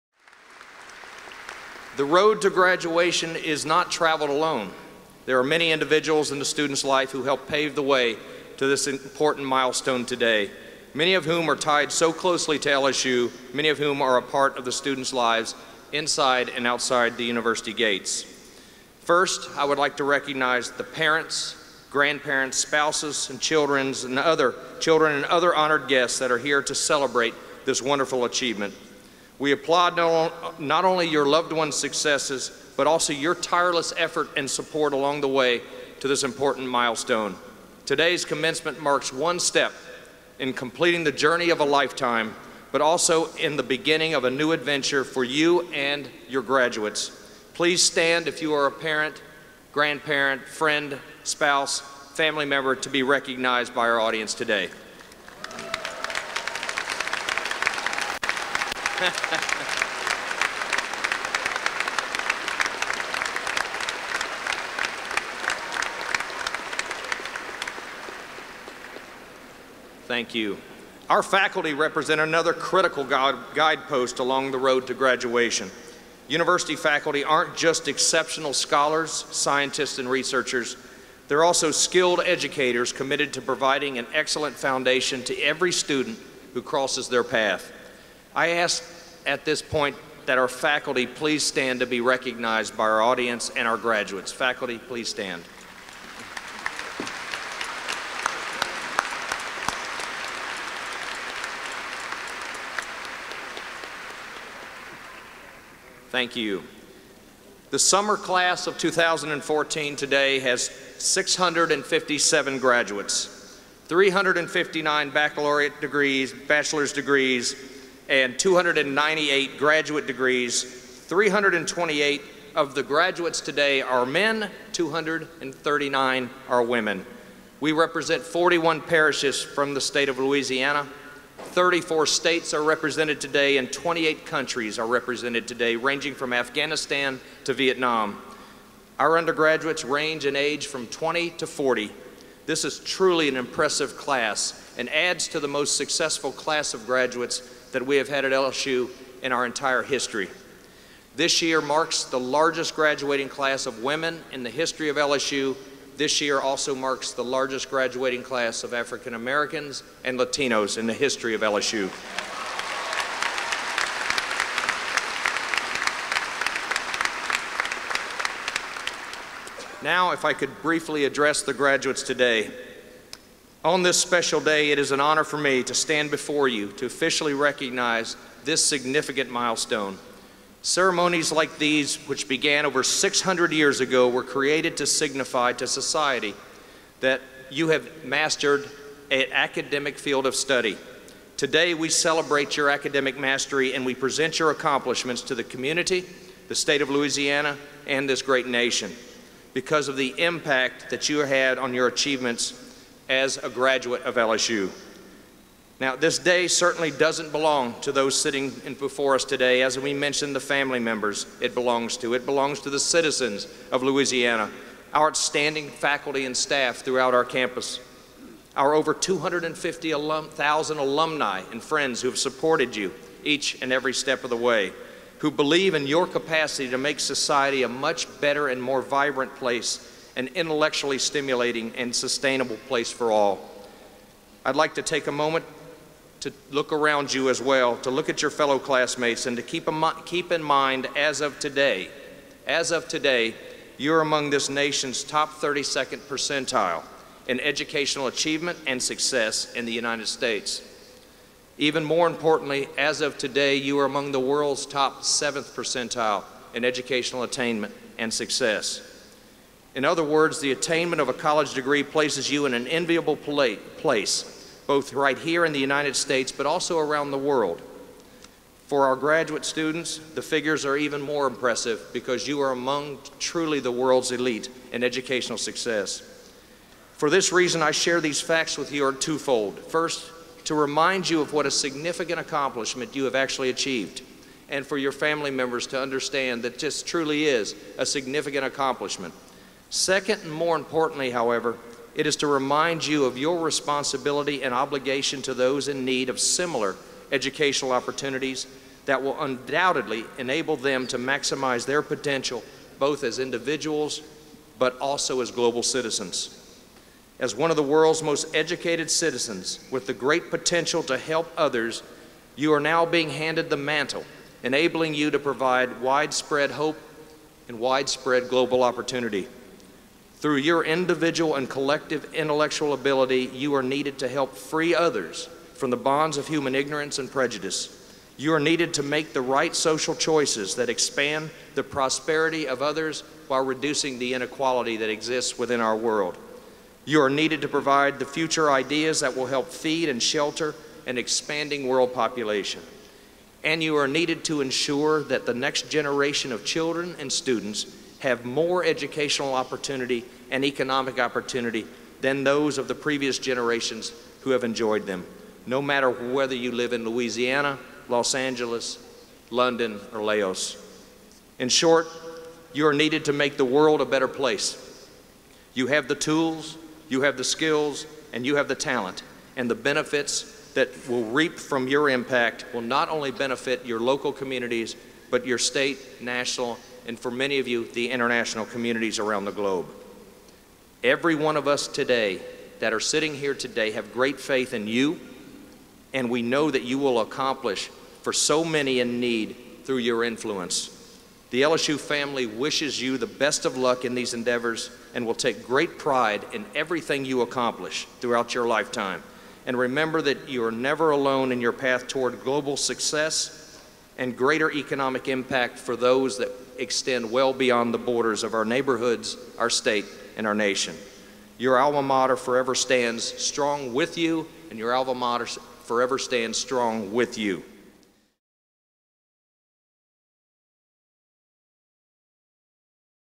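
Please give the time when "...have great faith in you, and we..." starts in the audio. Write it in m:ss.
6:23.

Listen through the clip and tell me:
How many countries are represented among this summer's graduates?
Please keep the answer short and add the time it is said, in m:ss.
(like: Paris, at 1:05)
28, at 2:13.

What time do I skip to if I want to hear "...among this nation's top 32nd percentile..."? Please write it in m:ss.
4:04.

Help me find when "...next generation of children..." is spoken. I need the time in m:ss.
5:45.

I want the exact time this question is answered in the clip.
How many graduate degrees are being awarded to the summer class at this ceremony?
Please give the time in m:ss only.
1:58.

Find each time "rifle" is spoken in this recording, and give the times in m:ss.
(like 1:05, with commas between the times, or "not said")
not said.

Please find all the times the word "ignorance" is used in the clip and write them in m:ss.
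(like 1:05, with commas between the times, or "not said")
5:26.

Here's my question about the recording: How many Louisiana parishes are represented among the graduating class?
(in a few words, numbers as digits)
41.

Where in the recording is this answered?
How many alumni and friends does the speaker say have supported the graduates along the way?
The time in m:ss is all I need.
3:38.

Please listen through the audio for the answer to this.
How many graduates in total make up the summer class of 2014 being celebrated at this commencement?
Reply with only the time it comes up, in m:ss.
1:50.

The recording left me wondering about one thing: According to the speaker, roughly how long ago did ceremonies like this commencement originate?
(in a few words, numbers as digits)
600 years.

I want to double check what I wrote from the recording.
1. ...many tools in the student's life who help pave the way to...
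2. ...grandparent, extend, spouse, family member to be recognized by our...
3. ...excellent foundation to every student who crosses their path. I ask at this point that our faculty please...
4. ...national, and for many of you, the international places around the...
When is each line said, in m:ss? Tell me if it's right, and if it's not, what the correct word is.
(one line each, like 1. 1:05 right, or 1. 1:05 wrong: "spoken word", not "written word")
1. 0:05 wrong: "individuals", not "tools"
2. 0:49 wrong: "friend", not "extend"
3. 1:24 right
4. 6:16 wrong: "communities", not "places".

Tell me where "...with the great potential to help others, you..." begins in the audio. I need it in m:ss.
5:09.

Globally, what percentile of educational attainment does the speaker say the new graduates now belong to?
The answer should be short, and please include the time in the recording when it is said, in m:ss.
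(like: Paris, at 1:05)
top 7th percentile, at 4:14.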